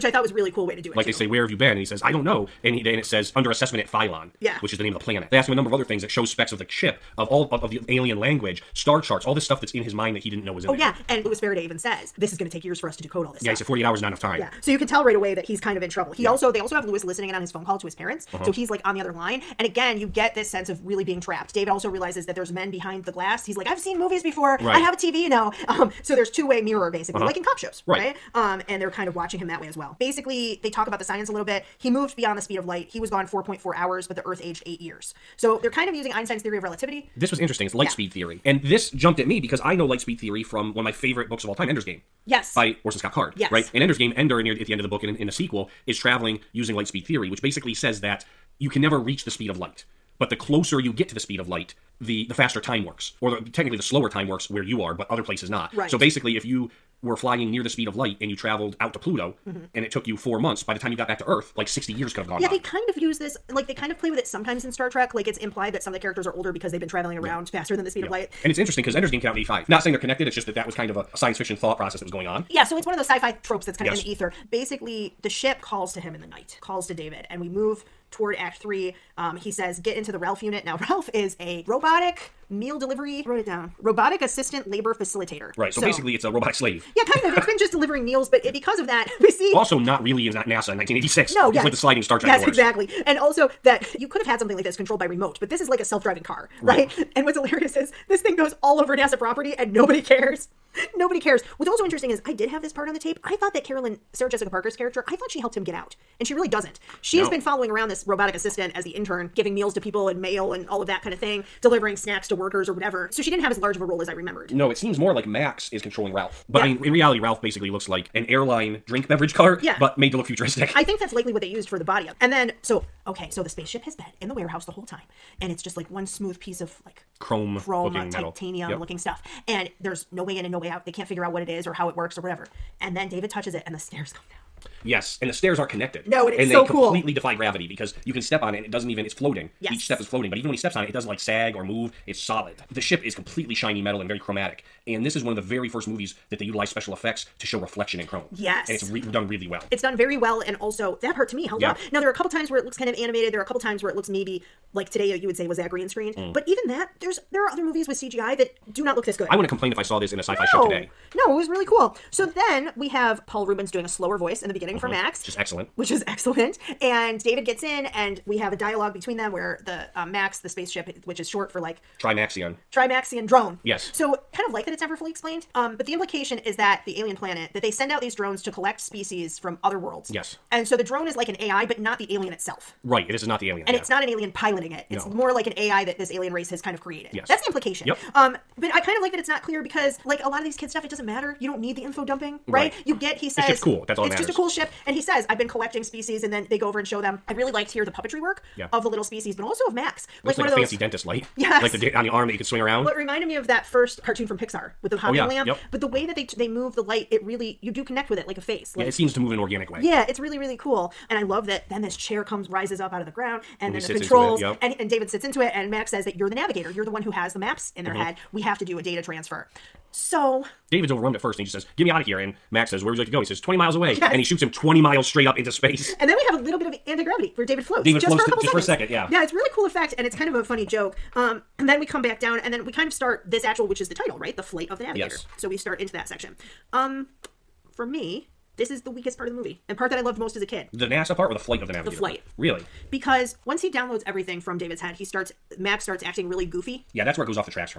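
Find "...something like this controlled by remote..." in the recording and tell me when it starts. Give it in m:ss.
1:34.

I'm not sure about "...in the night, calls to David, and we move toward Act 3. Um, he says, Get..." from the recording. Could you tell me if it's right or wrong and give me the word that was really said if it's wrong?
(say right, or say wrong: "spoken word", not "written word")
right.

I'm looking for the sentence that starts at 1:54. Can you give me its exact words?
No, it seems more like Max is controlling Ralph.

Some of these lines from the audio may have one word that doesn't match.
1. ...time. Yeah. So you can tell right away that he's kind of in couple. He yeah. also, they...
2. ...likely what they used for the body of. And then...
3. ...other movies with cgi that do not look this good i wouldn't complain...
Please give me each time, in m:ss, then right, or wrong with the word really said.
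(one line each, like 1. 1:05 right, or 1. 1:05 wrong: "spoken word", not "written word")
1. 0:14 wrong: "trouble", not "couple"
2. 2:01 right
3. 2:37 right.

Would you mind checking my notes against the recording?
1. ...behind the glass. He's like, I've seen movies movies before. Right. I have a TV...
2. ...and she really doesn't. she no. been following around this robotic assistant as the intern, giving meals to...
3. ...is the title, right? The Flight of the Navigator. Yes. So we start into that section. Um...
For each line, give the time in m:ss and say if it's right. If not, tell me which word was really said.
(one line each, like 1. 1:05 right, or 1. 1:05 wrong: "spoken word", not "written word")
1. 0:22 right
2. 1:46 right
3. 3:53 right.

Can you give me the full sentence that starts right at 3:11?
You don't need the info dumping, right?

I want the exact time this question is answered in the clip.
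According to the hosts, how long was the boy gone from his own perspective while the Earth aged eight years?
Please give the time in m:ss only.
0:33.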